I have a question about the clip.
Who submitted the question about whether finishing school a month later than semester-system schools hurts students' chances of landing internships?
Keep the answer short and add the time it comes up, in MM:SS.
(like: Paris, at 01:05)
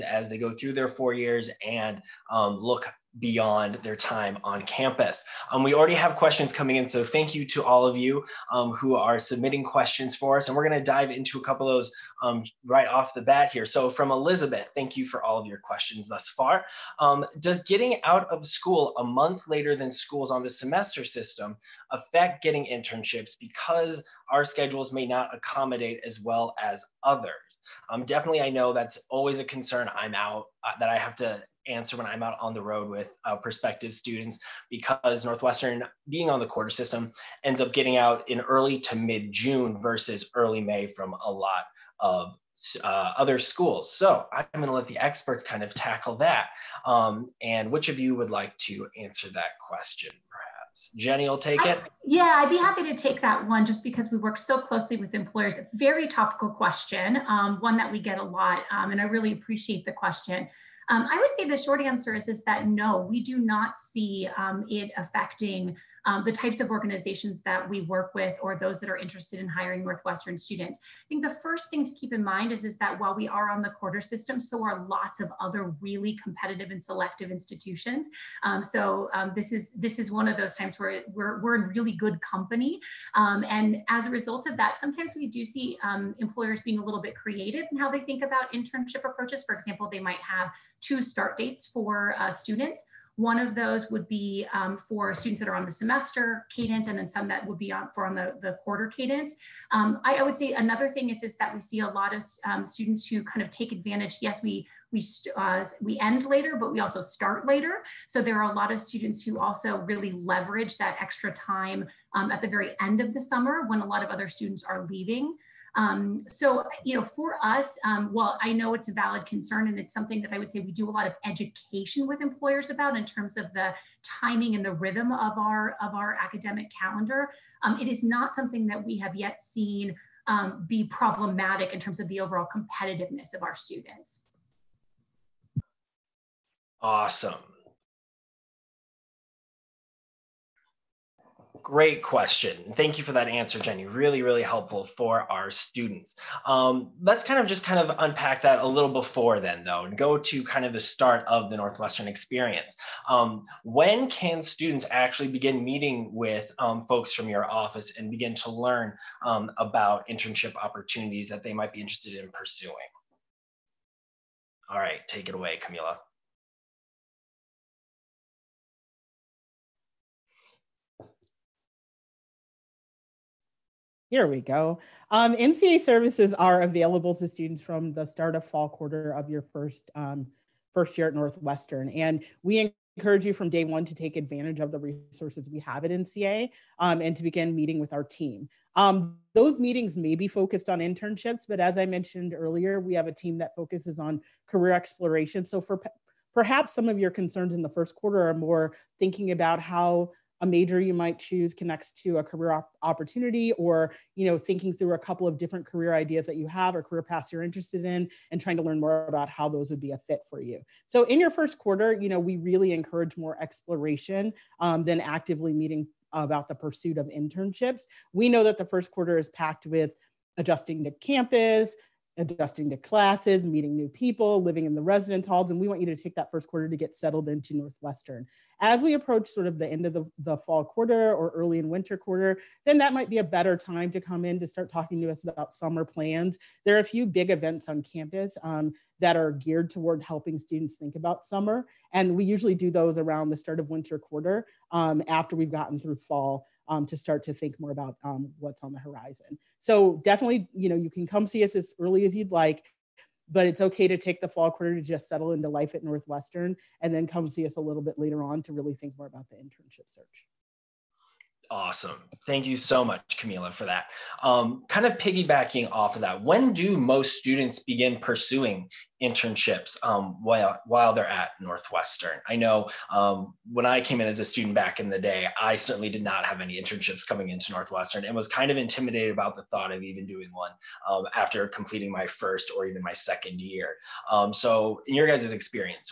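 Elizabeth, at 00:14.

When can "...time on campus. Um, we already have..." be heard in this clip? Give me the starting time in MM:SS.
00:03.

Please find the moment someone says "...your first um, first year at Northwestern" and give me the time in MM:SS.
02:59.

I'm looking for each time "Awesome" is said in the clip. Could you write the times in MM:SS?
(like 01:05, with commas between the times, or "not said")
02:16, 04:21.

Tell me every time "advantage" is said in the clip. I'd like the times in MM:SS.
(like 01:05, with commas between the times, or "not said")
01:43, 03:04.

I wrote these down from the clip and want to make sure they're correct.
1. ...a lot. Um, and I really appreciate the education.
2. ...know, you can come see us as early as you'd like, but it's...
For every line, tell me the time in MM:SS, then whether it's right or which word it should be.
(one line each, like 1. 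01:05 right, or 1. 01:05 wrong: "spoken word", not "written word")
1. 00:58 wrong: "question", not "education"
2. 04:10 right.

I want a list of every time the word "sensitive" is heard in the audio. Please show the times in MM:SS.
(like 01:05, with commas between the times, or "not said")
not said.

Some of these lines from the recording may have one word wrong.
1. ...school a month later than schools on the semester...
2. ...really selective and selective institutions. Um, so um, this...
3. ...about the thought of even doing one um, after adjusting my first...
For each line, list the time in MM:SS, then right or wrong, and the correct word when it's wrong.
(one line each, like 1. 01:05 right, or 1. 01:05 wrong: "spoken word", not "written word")
1. 00:18 right
2. 01:15 wrong: "competitive", not "selective"
3. 04:39 wrong: "completing", not "adjusting".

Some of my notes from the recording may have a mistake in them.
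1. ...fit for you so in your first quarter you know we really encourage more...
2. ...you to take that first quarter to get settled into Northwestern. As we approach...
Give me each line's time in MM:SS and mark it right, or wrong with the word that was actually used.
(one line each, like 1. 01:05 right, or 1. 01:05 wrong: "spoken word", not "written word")
1. 03:30 right
2. 03:45 right.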